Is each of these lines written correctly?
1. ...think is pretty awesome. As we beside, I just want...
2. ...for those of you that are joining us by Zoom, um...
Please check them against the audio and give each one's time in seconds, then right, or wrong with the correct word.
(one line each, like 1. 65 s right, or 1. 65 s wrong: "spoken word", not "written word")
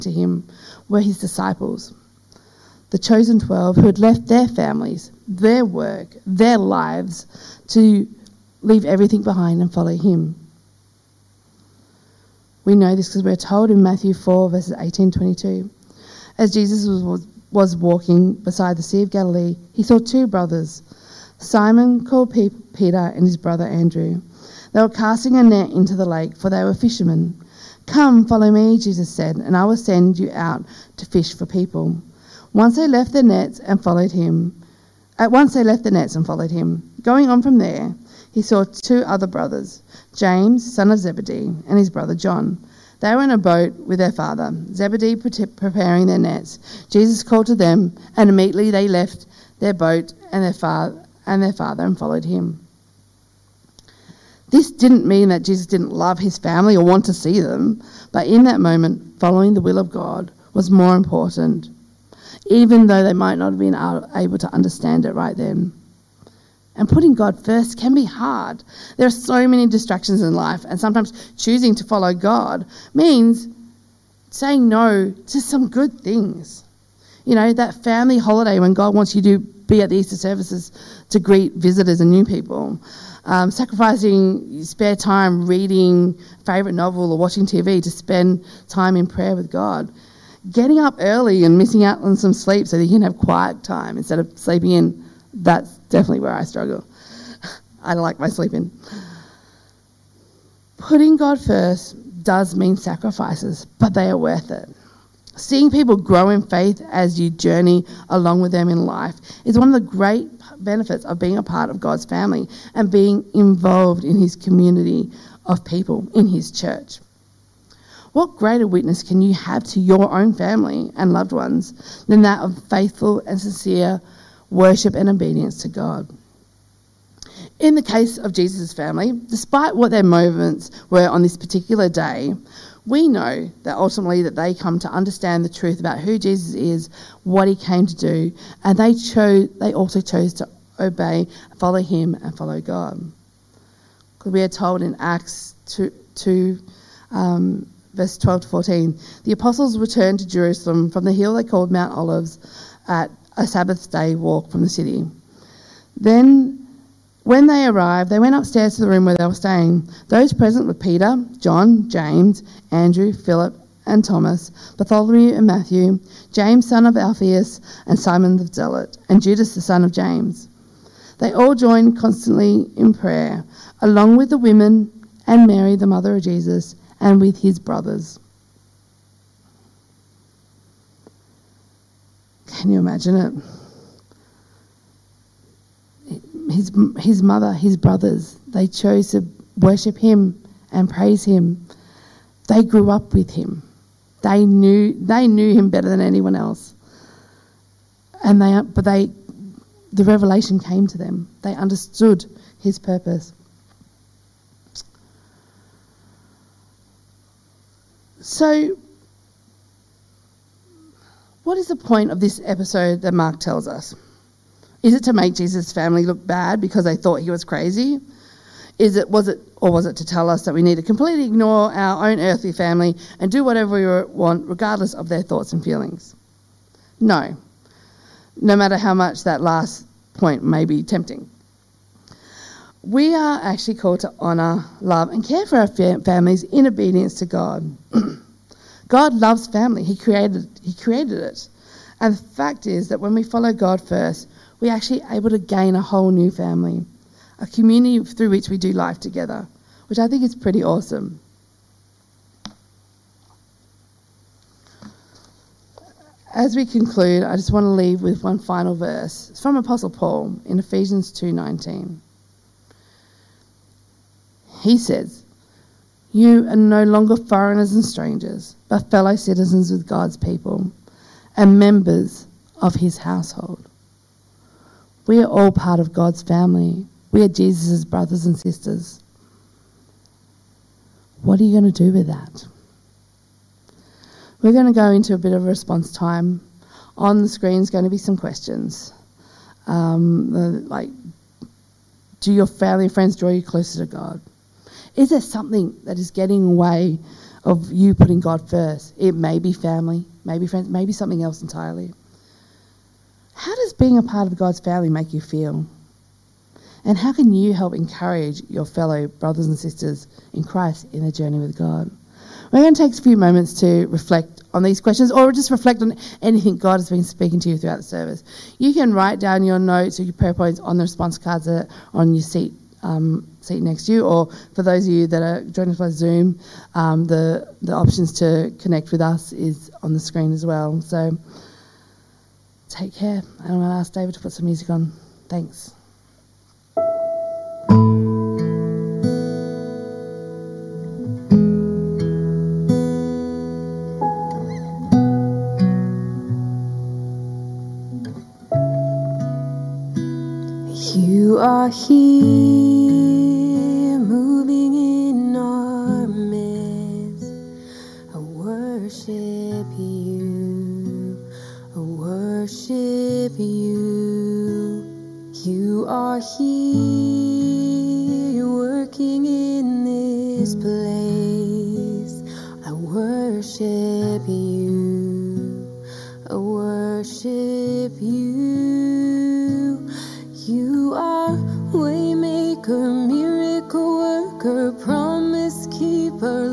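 1. 250 s wrong: "conclude", not "beside"
2. 324 s right.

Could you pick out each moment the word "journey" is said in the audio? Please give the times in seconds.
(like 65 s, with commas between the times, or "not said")
107 s, 311 s.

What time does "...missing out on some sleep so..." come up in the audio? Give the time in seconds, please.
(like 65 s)
91 s.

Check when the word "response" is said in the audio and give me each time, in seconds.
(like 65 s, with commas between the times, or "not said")
285 s, 320 s.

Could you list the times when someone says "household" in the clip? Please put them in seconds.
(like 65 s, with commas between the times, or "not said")
272 s.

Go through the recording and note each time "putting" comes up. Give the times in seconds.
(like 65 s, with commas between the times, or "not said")
66 s, 100 s, 297 s.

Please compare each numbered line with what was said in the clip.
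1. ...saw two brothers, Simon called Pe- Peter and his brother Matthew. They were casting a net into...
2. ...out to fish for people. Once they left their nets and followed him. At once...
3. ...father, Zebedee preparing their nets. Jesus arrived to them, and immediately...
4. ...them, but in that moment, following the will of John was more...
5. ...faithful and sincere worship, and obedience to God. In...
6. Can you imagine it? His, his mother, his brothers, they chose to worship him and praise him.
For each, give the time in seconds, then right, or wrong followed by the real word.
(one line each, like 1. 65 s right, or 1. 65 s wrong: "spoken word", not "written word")
1. 19 s wrong: "Andrew", not "Matthew"
2. 30 s right
3. 44 s wrong: "called", not "arrived"
4. 57 s wrong: "God", not "John"
5. 122 s right
6. 182 s right.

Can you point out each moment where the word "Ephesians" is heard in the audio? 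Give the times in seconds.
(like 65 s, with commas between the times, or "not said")
260 s.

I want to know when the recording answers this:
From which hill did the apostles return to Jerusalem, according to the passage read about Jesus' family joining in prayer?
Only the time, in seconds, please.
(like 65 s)
151 s.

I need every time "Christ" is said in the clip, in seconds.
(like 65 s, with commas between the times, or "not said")
310 s.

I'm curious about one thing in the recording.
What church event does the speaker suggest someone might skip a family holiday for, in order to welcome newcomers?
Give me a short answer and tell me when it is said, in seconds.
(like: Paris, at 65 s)
Easter services, at 79 s.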